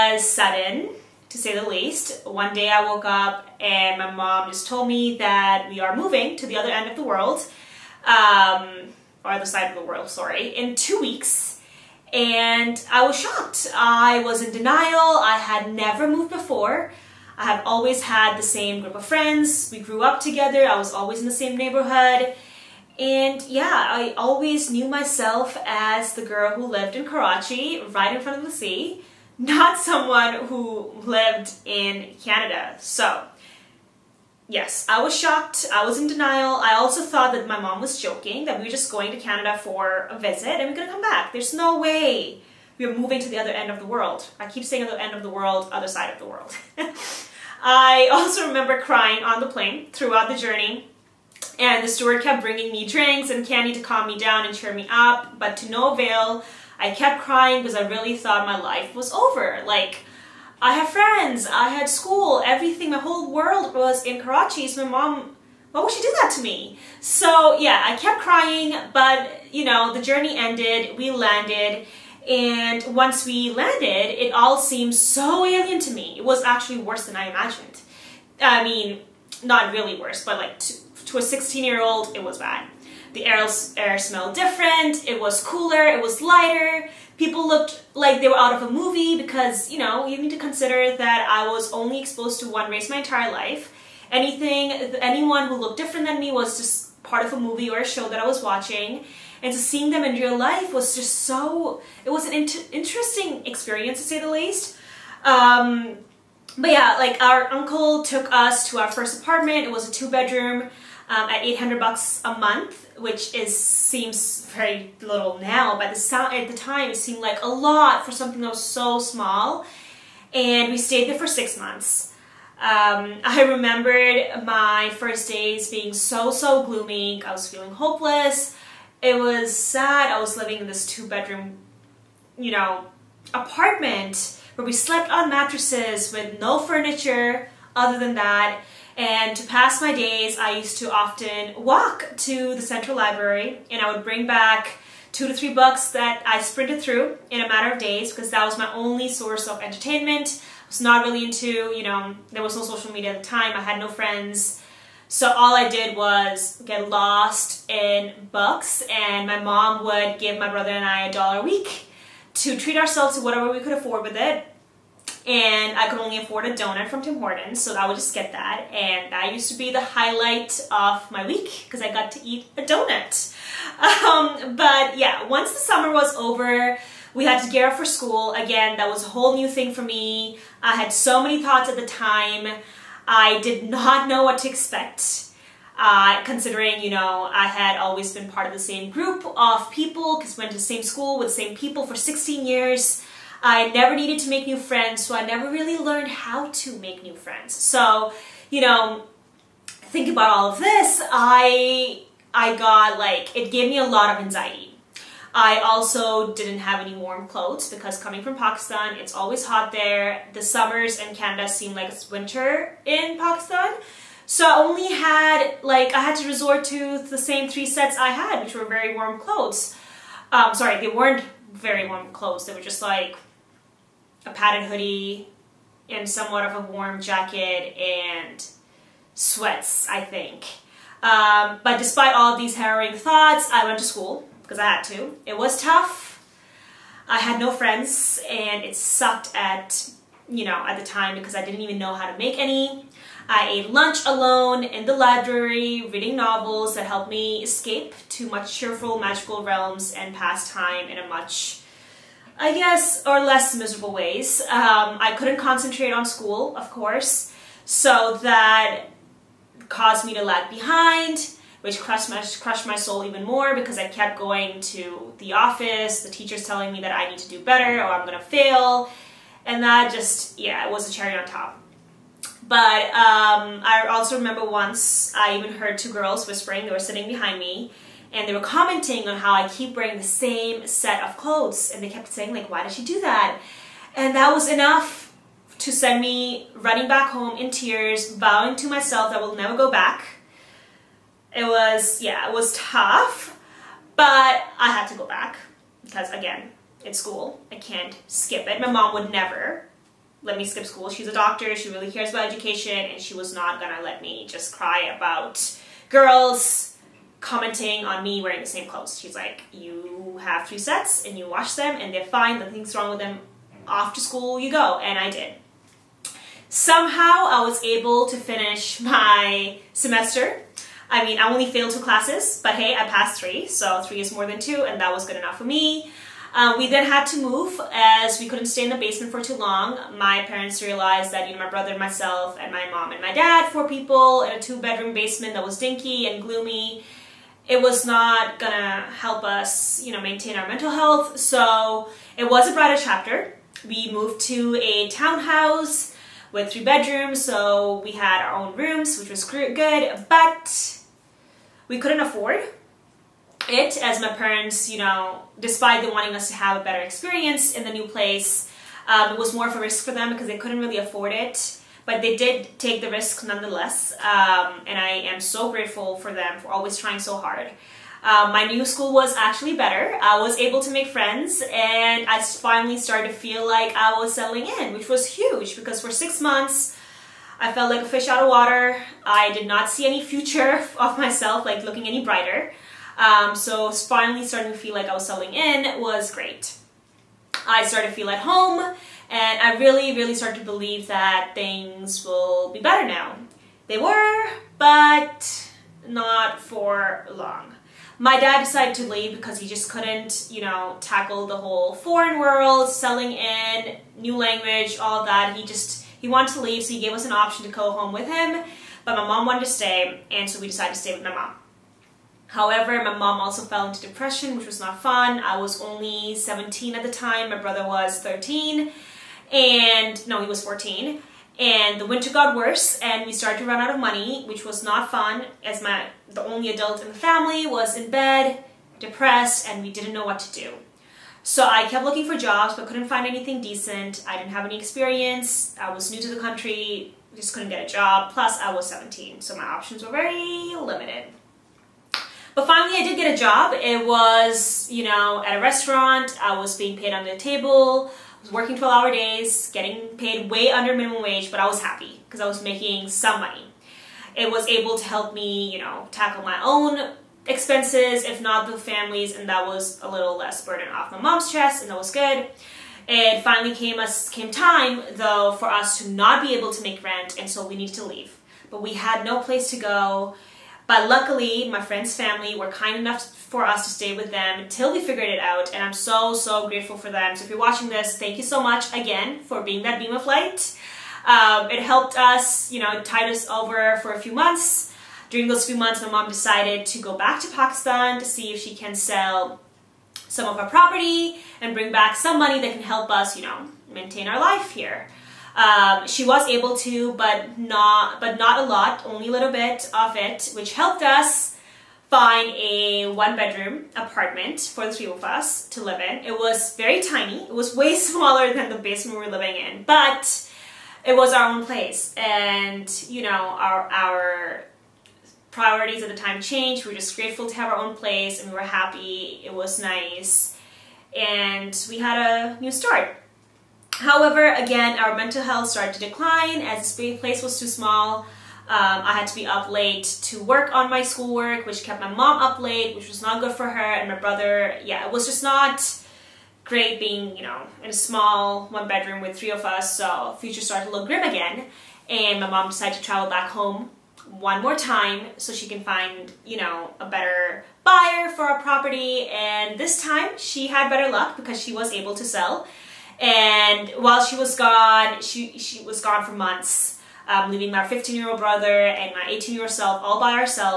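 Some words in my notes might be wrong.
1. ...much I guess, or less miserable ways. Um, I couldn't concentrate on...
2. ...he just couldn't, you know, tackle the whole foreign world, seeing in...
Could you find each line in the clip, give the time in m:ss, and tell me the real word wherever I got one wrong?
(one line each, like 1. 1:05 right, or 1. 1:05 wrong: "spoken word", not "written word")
1. 4:11 right
2. 6:39 wrong: "selling", not "seeing".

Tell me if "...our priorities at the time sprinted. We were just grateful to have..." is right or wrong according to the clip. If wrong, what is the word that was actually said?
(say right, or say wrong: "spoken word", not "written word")
wrong: "changed", not "sprinted".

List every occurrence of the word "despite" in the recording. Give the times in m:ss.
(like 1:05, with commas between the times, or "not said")
3:51, 5:55.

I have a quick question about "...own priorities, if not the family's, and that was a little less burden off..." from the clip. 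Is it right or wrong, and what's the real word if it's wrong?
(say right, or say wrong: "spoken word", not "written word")
wrong: "expenses", not "priorities".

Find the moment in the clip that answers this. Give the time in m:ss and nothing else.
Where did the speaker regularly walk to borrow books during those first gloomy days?
2:22.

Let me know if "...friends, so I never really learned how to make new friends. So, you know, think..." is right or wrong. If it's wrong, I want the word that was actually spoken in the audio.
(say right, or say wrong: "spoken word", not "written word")
right.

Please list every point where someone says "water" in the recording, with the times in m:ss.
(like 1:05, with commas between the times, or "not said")
6:18.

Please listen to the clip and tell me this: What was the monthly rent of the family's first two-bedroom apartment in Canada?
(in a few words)
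$800.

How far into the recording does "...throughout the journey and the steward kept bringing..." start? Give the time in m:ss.
0:49.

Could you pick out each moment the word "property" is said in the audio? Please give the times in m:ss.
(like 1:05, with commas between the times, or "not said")
8:10, 9:08.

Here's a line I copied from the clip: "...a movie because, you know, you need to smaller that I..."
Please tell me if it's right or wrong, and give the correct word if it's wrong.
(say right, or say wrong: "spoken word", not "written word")
wrong: "consider", not "smaller".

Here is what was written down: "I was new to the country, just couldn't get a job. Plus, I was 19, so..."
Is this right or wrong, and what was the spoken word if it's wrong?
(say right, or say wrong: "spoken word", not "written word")
wrong: "17", not "19".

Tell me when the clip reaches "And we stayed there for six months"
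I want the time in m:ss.
2:00.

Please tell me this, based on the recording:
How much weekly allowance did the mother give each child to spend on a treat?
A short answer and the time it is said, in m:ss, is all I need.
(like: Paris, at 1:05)
a dollar, at 2:41.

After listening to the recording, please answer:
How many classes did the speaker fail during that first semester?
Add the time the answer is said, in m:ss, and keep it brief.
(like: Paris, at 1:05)
2, at 5:21.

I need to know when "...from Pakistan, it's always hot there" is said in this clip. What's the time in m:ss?
3:28.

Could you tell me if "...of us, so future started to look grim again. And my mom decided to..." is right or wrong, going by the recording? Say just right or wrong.
right.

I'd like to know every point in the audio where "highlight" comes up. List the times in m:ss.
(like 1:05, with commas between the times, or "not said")
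2:49.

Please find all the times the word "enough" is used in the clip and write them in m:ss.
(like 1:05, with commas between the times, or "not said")
4:44, 5:25, 7:52.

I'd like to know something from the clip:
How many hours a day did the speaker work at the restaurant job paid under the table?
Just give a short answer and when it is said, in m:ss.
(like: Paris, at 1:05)
12, at 7:28.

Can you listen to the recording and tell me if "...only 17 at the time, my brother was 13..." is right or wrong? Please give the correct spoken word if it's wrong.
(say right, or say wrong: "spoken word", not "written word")
right.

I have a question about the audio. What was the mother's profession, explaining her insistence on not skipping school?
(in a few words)
doctor.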